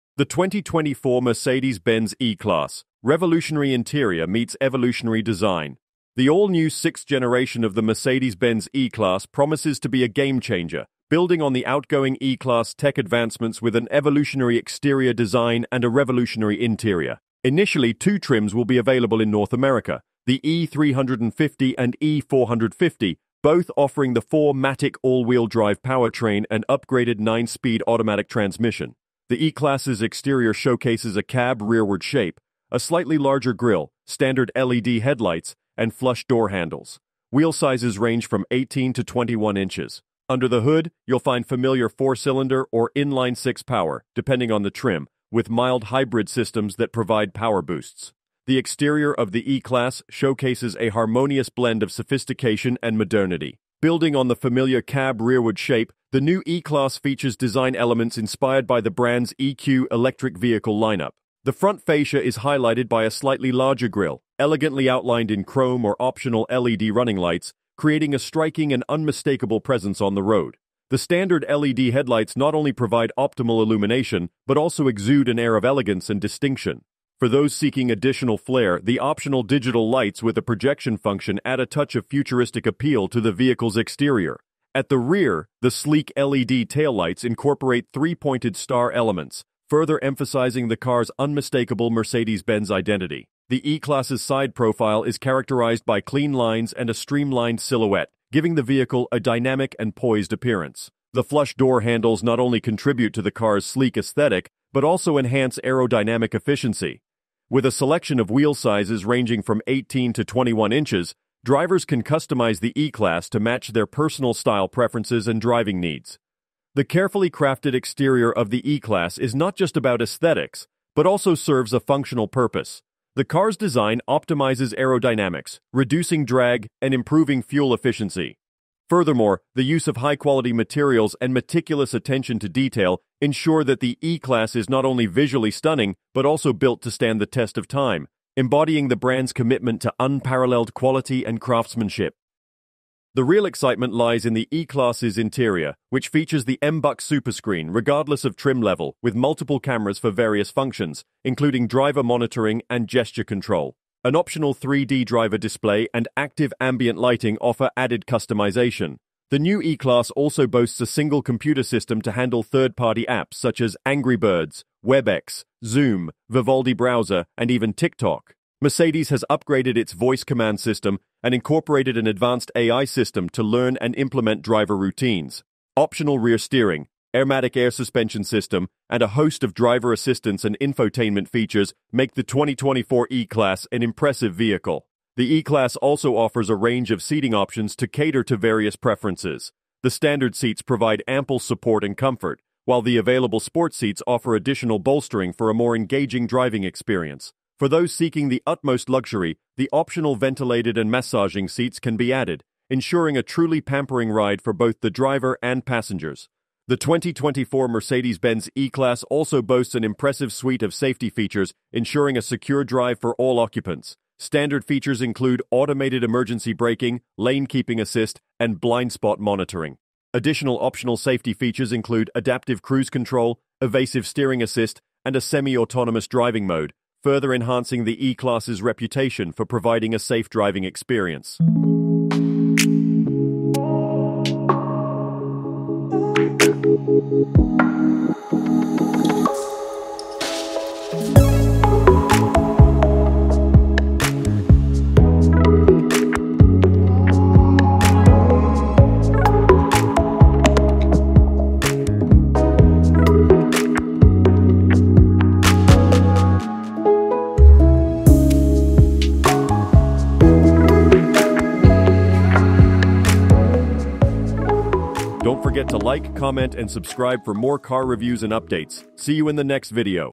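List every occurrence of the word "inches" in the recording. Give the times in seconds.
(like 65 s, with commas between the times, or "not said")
39 s, 110 s.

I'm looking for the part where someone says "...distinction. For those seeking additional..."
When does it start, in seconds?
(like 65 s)
76 s.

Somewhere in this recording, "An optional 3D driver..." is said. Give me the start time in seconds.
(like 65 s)
154 s.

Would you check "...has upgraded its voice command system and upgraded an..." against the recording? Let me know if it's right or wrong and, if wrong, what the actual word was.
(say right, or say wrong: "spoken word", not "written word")
wrong: "incorporated", not "upgraded".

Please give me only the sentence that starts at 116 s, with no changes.
The carefully crafted exterior of the E-Class is not just about aesthetics, but also serves a functional purpose.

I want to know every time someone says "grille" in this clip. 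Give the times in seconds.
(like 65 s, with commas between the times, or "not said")
33 s, 63 s.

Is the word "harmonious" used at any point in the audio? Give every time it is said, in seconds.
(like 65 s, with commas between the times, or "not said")
50 s.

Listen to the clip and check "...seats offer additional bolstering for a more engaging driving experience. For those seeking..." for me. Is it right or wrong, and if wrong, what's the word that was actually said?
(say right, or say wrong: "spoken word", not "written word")
right.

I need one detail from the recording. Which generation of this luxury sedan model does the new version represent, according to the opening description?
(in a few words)
Sixth.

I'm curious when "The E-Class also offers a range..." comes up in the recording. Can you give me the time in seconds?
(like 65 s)
185 s.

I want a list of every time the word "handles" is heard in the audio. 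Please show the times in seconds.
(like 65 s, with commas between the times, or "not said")
36 s, 101 s, 162 s.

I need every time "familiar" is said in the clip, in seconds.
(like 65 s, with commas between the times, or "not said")
41 s, 54 s.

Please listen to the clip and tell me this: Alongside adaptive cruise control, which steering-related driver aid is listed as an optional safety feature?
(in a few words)
Evasive steering assist.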